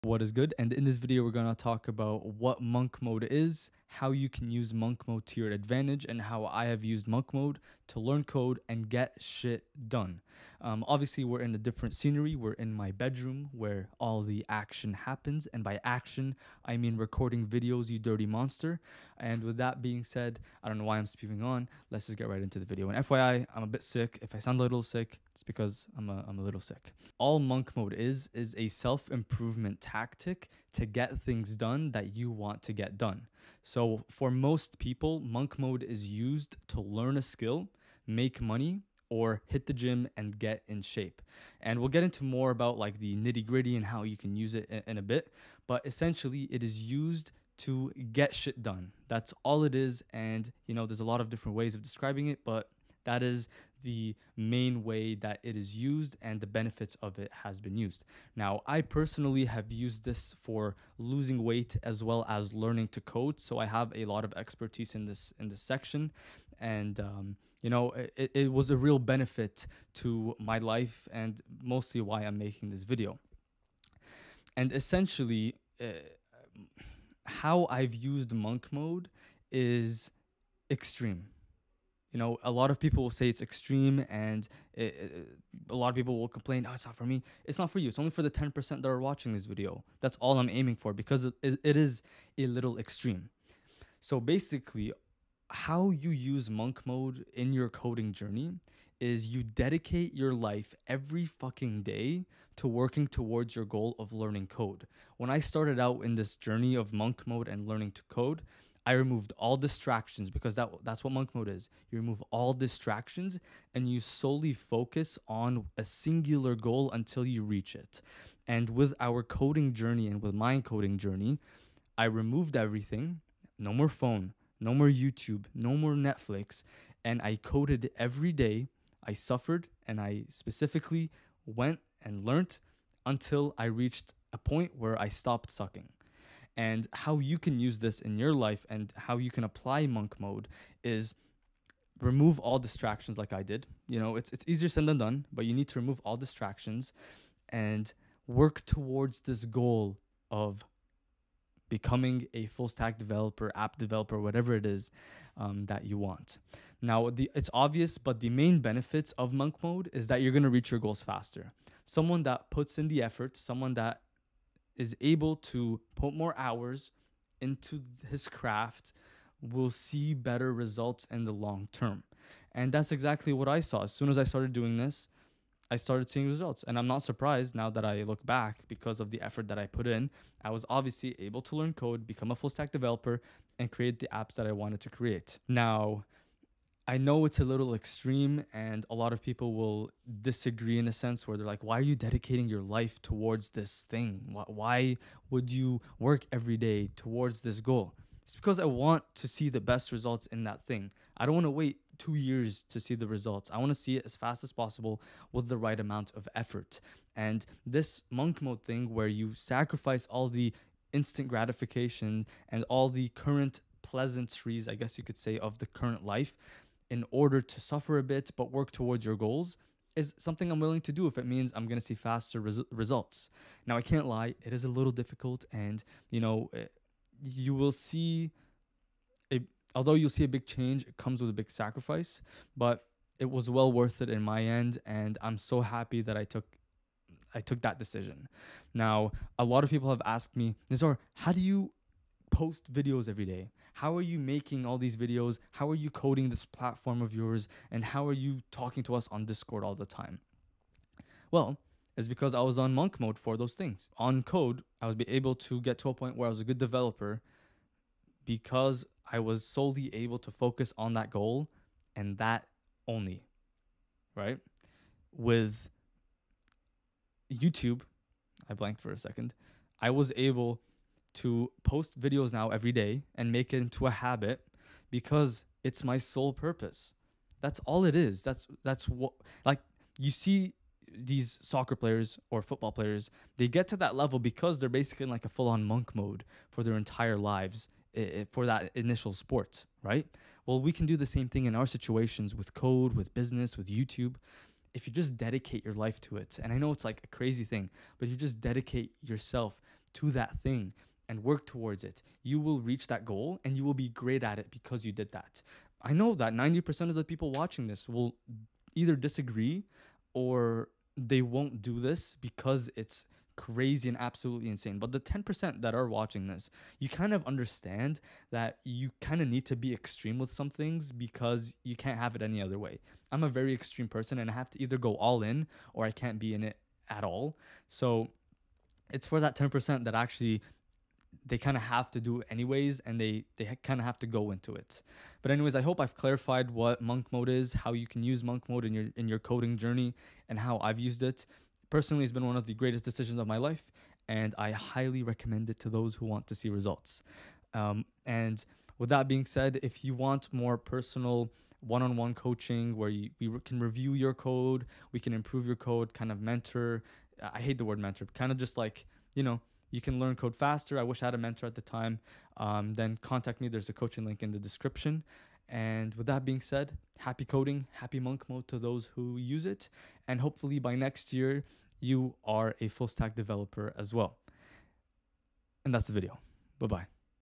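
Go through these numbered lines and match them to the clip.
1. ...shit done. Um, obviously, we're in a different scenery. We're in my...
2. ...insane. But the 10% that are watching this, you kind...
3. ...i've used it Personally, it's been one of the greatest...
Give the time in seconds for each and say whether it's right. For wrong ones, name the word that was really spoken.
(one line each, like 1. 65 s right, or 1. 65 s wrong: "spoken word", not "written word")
1. 9 s right
2. 314 s right
3. 340 s right.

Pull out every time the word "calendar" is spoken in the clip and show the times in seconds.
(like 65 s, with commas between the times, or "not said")
not said.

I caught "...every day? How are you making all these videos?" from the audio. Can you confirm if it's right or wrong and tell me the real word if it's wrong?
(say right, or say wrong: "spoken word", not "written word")
right.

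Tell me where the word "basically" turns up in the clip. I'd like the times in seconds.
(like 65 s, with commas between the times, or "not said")
94 s, 284 s.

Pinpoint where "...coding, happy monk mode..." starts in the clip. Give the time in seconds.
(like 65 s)
367 s.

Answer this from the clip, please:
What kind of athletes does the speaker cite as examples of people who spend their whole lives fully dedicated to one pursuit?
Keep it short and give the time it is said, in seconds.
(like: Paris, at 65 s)
soccer players, at 281 s.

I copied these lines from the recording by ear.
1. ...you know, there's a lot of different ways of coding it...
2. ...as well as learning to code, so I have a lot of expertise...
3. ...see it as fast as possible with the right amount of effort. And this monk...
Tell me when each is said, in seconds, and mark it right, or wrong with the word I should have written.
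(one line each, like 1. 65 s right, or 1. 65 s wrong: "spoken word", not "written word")
1. 50 s wrong: "describing", not "coding"
2. 61 s right
3. 203 s right.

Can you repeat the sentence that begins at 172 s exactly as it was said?
And that's exactly what I saw.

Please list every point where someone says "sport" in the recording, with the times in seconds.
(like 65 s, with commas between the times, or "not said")
289 s.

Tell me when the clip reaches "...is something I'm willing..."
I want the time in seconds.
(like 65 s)
219 s.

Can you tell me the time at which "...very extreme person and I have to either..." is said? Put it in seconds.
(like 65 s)
323 s.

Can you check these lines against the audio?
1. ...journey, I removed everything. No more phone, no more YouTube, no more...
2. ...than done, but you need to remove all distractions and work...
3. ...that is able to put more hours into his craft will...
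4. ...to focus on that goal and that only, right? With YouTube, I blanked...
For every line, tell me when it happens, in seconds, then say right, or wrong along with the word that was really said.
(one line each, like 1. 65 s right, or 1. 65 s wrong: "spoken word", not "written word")
1. 120 s right
2. 144 s right
3. 163 s right
4. 260 s right.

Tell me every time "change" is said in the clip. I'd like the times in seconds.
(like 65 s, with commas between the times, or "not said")
230 s.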